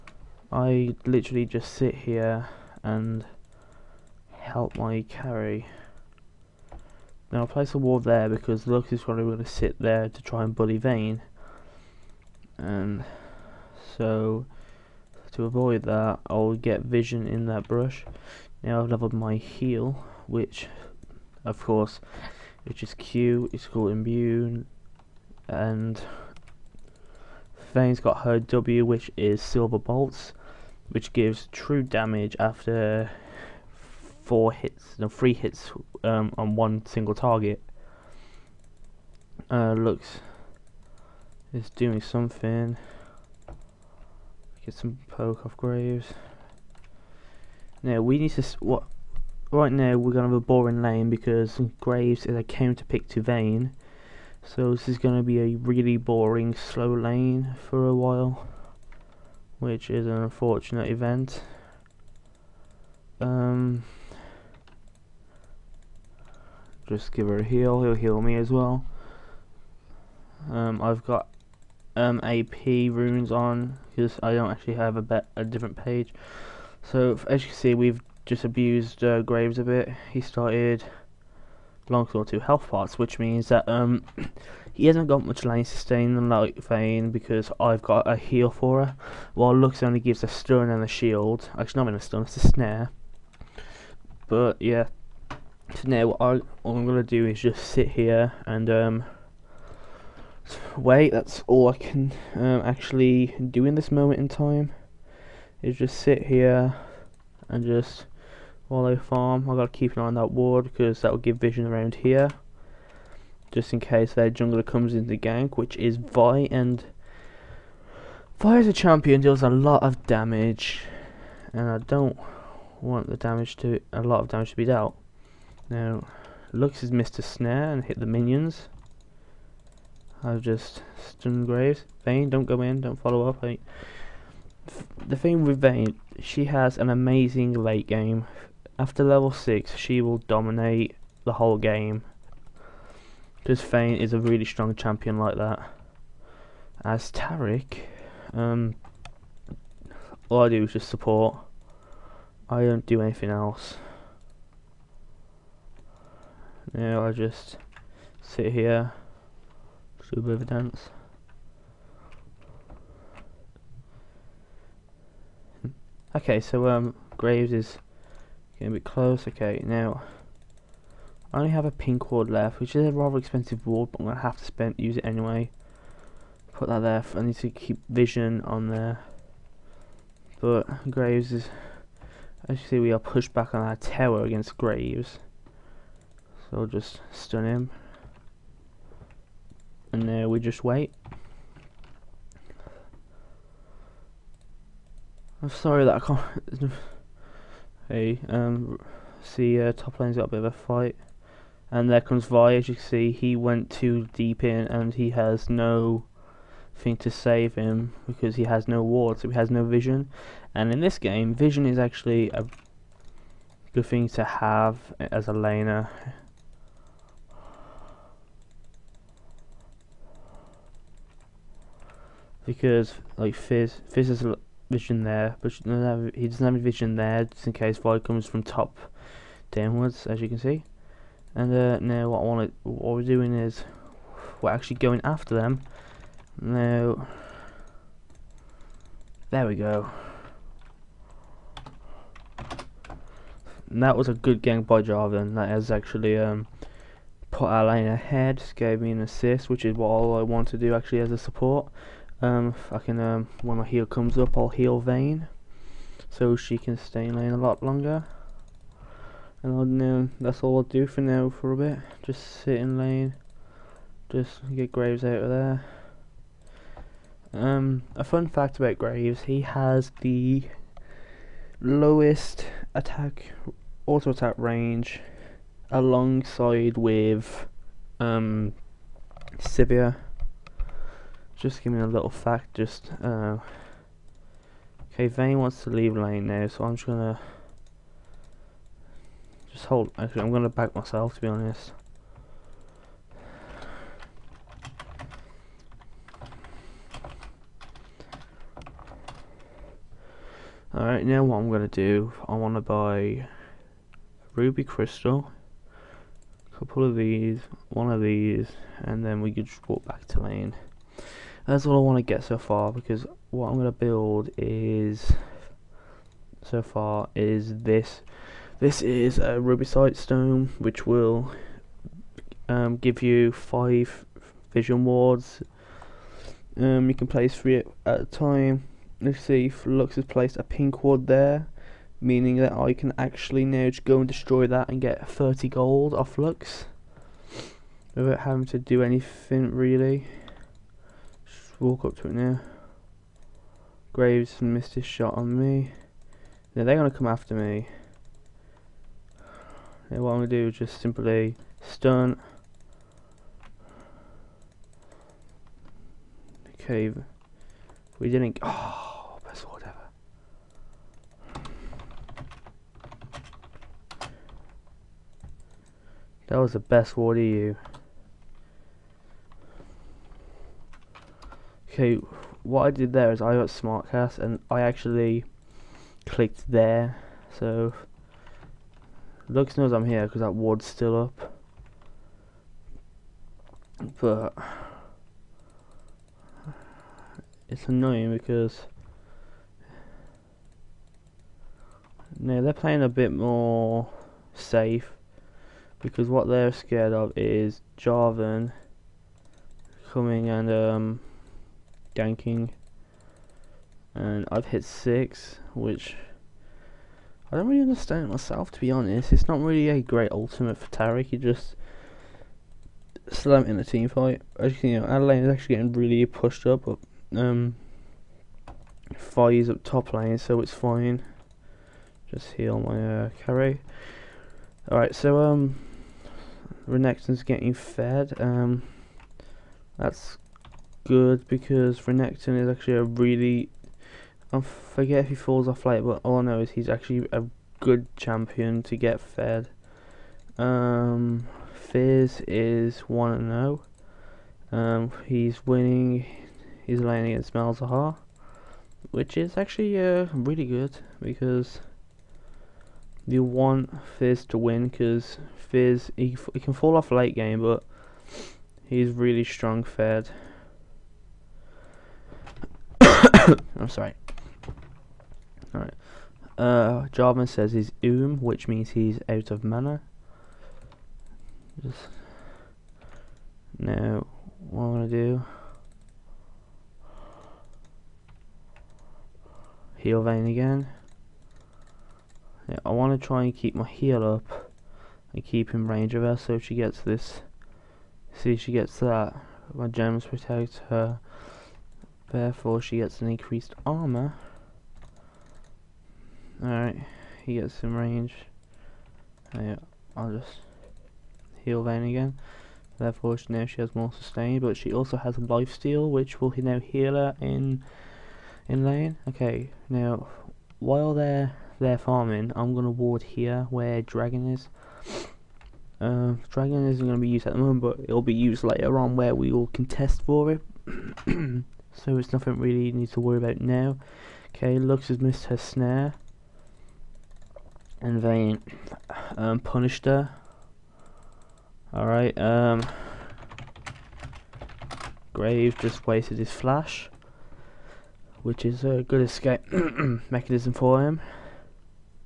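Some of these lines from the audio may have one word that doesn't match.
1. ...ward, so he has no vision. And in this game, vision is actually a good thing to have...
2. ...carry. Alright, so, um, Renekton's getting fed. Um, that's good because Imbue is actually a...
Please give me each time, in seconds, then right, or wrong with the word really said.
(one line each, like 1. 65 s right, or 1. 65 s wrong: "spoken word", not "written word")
1. 208 s right
2. 423 s wrong: "Renekton", not "Imbue".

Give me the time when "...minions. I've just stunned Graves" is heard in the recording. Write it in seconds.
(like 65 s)
128 s.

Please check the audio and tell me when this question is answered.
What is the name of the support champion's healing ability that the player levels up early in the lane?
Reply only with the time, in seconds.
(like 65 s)
23 s.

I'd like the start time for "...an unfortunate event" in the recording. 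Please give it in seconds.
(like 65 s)
60 s.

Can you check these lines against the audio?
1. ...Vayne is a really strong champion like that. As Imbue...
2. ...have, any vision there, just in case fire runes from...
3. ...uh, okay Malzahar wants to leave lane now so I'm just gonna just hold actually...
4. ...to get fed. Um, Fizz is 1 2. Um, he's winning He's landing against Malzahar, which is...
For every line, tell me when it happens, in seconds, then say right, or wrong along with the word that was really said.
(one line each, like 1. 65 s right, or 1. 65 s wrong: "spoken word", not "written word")
1. 143 s wrong: "Taric", not "Imbue"
2. 225 s wrong: "comes", not "runes"
3. 283 s wrong: "Vayne", not "Malzahar"
4. 438 s wrong: "0", not "2".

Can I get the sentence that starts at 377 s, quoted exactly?
So, Lux knows I'm here because that ward's still up.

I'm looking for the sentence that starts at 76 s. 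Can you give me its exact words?
So as you can see, we've just abused uh, Graves a bit.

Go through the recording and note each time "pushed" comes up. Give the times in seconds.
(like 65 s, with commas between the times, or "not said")
182 s, 416 s.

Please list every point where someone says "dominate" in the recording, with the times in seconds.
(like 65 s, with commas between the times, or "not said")
140 s.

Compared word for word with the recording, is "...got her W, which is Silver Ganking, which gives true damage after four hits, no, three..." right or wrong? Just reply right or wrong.
wrong.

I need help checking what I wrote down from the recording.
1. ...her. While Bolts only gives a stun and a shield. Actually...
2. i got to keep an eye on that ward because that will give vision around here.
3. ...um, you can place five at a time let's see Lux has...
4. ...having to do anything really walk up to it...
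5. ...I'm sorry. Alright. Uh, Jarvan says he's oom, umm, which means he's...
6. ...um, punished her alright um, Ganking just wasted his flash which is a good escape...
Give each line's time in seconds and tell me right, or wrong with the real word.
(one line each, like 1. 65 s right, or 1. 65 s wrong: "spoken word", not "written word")
1. 88 s wrong: "Lux", not "Bolts"
2. 109 s right
3. 326 s wrong: "three", not "five"
4. 338 s right
5. 463 s right
6. 529 s wrong: "Graves", not "Ganking".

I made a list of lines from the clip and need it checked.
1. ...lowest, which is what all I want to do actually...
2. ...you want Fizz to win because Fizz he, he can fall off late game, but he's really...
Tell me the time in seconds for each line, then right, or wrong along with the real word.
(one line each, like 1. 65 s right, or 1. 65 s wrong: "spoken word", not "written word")
1. 248 s wrong: "assist", not "lowest"
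2. 453 s right.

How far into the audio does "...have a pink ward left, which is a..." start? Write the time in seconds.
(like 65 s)
171 s.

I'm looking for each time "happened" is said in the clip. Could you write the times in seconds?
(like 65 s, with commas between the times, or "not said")
not said.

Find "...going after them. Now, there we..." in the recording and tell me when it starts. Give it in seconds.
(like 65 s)
234 s.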